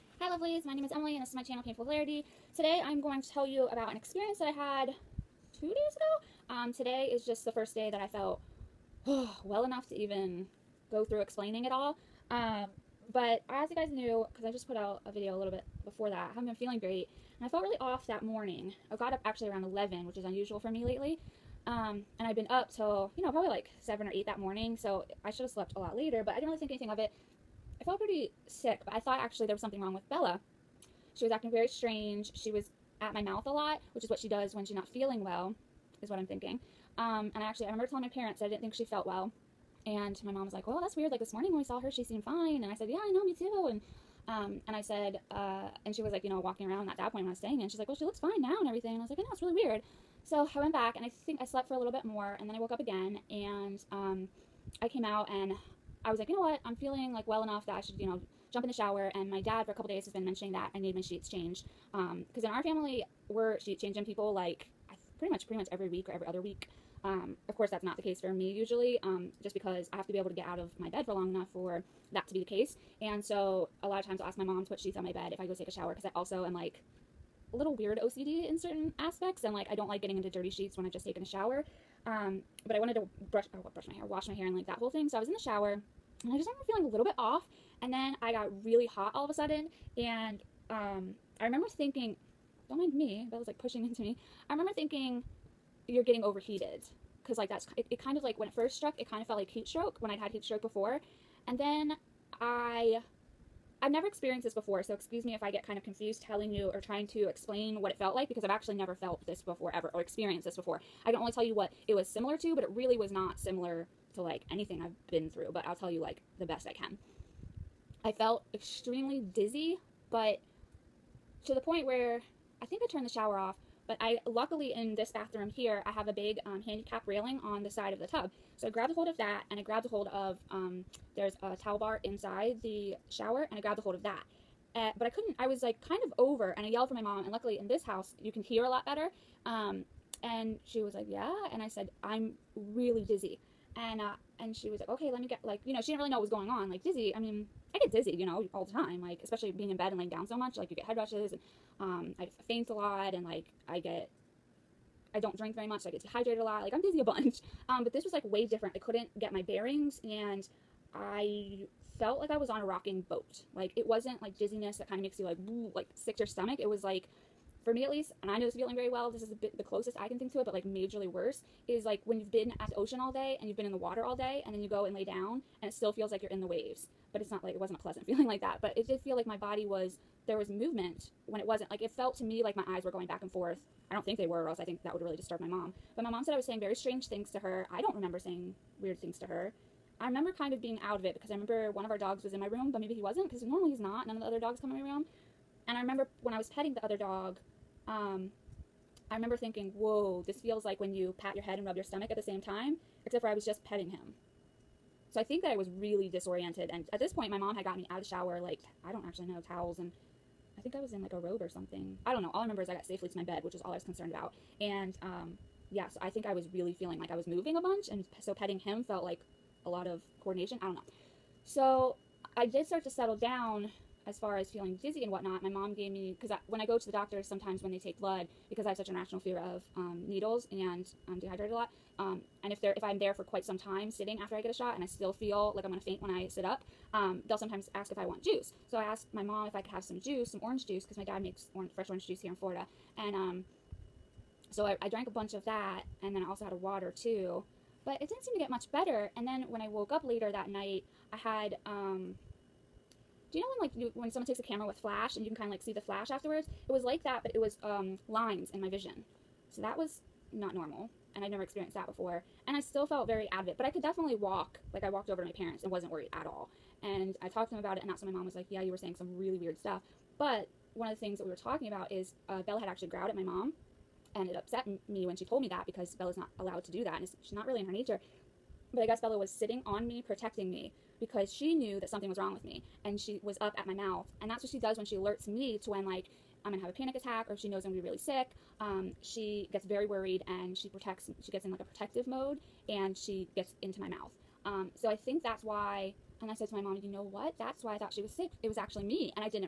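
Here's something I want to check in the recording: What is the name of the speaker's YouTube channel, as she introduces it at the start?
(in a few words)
Painful Hilarity.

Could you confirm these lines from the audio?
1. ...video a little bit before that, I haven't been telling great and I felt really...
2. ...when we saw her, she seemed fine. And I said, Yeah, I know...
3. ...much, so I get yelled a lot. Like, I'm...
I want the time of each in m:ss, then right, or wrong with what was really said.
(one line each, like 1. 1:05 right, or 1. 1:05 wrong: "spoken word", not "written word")
1. 0:15 wrong: "feeling", not "telling"
2. 0:41 right
3. 2:35 wrong: "dehydrated", not "yelled".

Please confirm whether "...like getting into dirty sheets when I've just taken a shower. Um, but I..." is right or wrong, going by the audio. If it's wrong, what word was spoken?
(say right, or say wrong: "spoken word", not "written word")
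right.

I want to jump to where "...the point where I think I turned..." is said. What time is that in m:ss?
2:01.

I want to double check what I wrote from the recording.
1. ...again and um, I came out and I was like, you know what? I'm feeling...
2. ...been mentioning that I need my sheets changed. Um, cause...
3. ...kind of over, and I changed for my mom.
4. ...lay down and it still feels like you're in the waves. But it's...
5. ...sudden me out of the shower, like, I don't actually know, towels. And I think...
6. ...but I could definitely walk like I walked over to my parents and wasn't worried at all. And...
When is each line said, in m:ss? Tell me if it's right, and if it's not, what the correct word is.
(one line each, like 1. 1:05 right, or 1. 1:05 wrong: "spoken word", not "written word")
1. 0:52 right
2. 1:00 right
3. 2:15 wrong: "yelled", not "changed"
4. 2:54 right
5. 3:27 wrong: "gotten", not "sudden"
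6. 4:23 right.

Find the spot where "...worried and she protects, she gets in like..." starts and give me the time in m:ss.
4:49.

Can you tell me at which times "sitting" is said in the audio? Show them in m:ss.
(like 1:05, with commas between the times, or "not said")
3:53, 4:39.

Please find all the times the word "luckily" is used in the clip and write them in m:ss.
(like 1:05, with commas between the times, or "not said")
2:04, 2:17.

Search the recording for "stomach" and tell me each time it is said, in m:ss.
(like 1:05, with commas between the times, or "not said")
2:46, 3:21.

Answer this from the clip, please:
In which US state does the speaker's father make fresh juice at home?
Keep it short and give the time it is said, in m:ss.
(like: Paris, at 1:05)
Florida, at 4:02.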